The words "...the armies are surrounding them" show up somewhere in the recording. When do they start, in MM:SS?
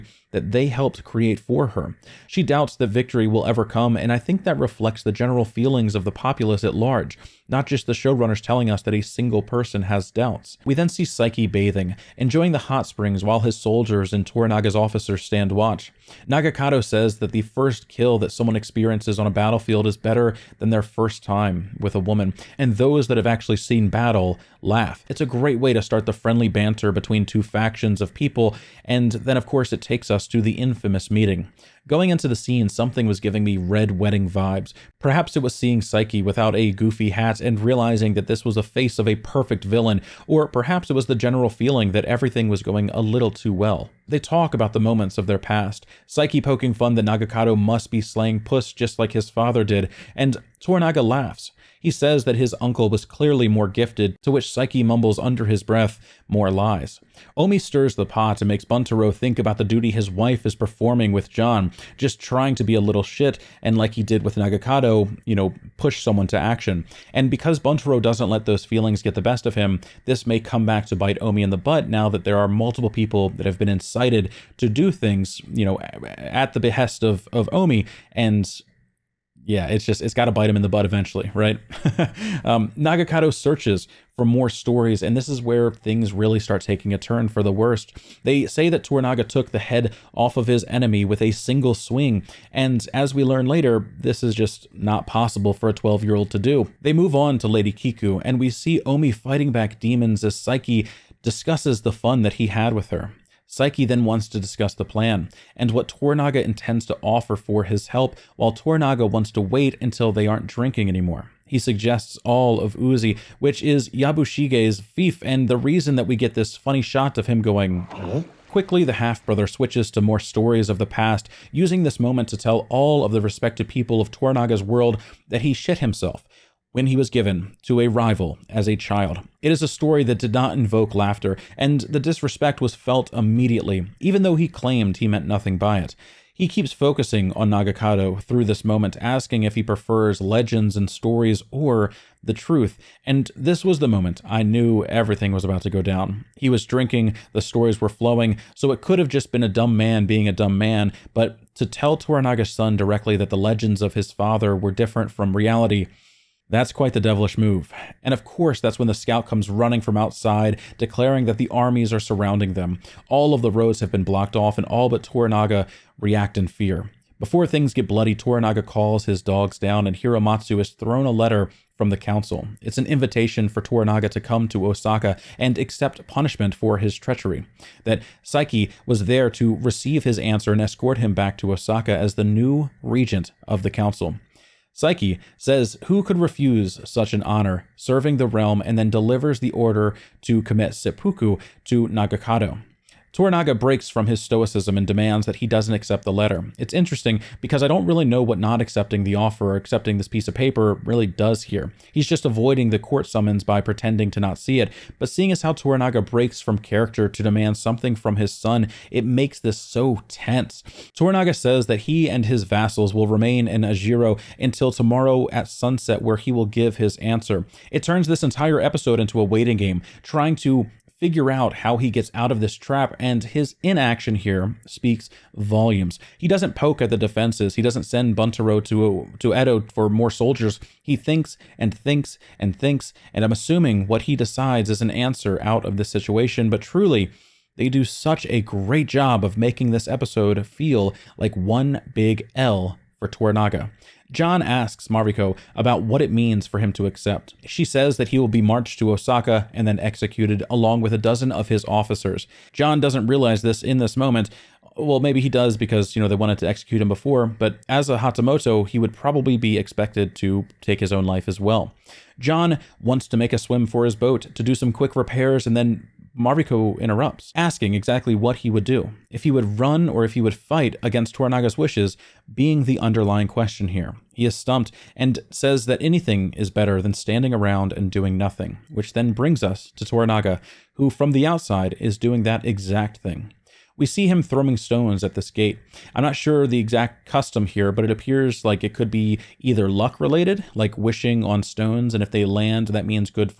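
02:41.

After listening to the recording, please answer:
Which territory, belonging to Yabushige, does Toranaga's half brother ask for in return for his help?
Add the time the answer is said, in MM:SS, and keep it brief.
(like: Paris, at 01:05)
Uzi, at 01:52.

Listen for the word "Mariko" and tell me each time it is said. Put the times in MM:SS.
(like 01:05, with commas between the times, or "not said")
04:04, 04:26.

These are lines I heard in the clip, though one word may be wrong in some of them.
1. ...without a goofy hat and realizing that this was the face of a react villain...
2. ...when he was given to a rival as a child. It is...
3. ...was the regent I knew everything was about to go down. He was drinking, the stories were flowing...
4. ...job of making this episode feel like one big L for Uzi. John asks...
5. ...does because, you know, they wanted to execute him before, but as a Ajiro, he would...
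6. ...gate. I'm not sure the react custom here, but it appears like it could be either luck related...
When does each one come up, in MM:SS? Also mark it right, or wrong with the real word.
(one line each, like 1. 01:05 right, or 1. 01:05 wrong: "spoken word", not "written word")
1. 00:36 wrong: "perfect", not "react"
2. 02:06 right
3. 02:23 wrong: "moment", not "regent"
4. 03:58 wrong: "Toranaga", not "Uzi"
5. 04:15 wrong: "Hatamoto", not "Ajiro"
6. 04:45 wrong: "exact", not "react".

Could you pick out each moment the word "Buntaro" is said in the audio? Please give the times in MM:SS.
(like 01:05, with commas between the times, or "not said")
00:58, 01:07, 03:48.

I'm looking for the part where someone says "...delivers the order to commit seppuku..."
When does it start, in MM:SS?
03:08.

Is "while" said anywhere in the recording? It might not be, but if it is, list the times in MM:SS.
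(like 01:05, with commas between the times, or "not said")
00:13, 01:48.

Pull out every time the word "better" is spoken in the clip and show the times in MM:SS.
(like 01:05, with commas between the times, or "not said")
00:19, 04:36.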